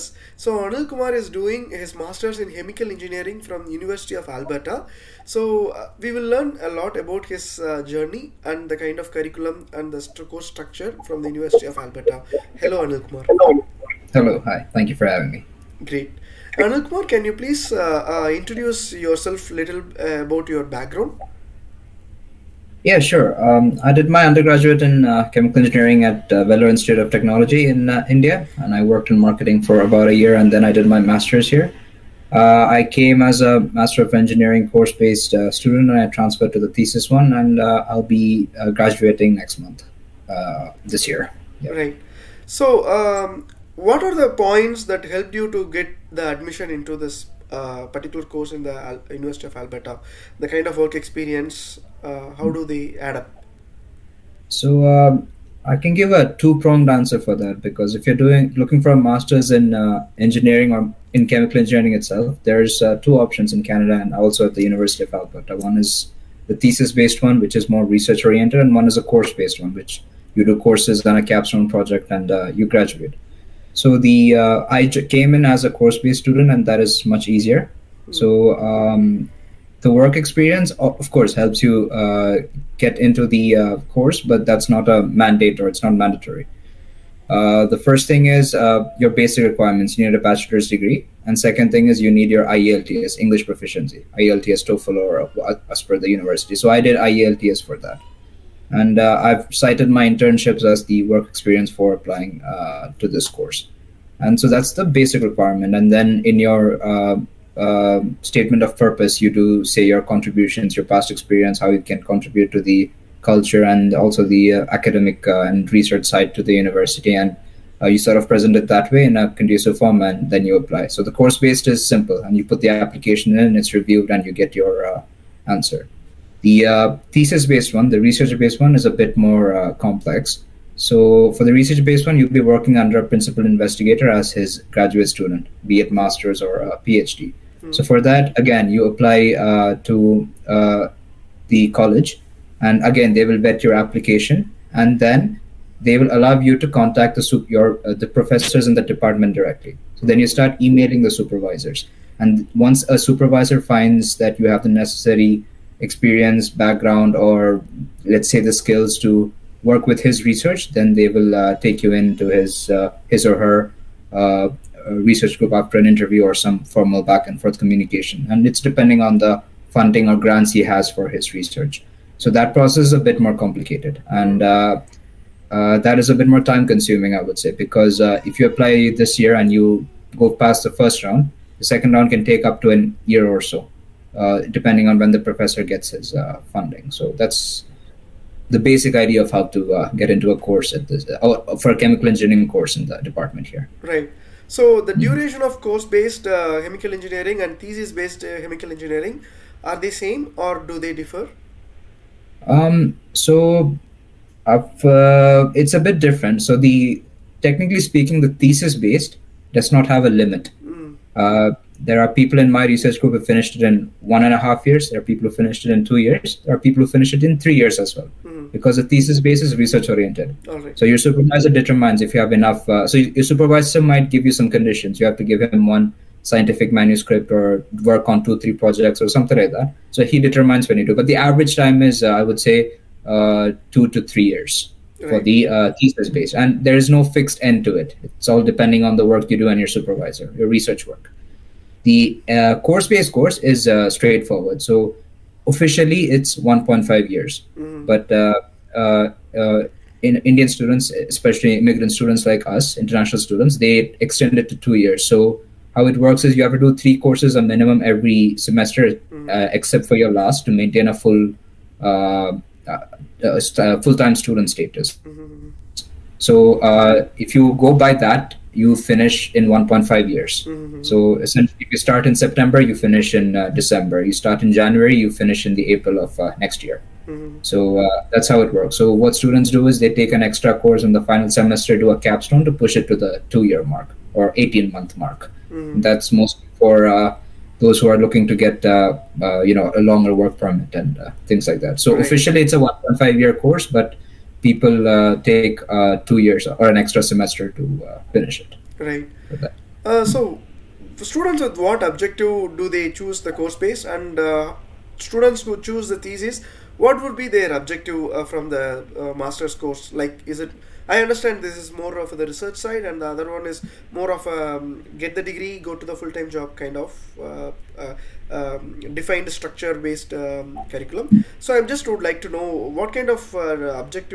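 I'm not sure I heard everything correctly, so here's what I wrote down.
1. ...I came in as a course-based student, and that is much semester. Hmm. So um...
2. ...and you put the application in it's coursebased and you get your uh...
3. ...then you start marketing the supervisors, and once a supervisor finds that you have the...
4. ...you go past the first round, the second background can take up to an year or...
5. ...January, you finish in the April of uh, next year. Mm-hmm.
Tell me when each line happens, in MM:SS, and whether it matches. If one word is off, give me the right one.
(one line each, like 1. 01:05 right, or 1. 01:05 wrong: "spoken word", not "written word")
1. 01:14 wrong: "easier", not "semester"
2. 02:02 wrong: "reviewed", not "coursebased"
3. 02:30 wrong: "emailing", not "marketing"
4. 02:59 wrong: "round", not "background"
5. 04:34 right.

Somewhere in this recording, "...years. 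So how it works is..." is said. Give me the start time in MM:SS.
04:14.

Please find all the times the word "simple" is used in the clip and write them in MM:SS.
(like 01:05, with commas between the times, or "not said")
02:01.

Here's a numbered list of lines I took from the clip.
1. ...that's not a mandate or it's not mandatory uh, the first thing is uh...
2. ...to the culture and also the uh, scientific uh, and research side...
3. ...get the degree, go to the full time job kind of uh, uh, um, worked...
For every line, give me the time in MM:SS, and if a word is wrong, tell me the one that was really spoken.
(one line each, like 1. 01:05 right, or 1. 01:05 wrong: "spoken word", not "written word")
1. 01:24 right
2. 01:52 wrong: "academic", not "scientific"
3. 05:14 wrong: "defined", not "worked".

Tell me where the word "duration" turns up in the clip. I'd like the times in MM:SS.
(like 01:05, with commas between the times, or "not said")
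03:15.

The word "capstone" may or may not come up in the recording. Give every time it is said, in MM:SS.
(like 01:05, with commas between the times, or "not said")
01:11, 04:41.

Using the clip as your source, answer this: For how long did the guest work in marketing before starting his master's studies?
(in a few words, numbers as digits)
About a year.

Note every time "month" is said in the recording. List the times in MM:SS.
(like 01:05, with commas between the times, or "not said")
00:39, 04:44.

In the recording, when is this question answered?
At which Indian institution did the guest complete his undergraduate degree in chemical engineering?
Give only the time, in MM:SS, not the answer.
00:26.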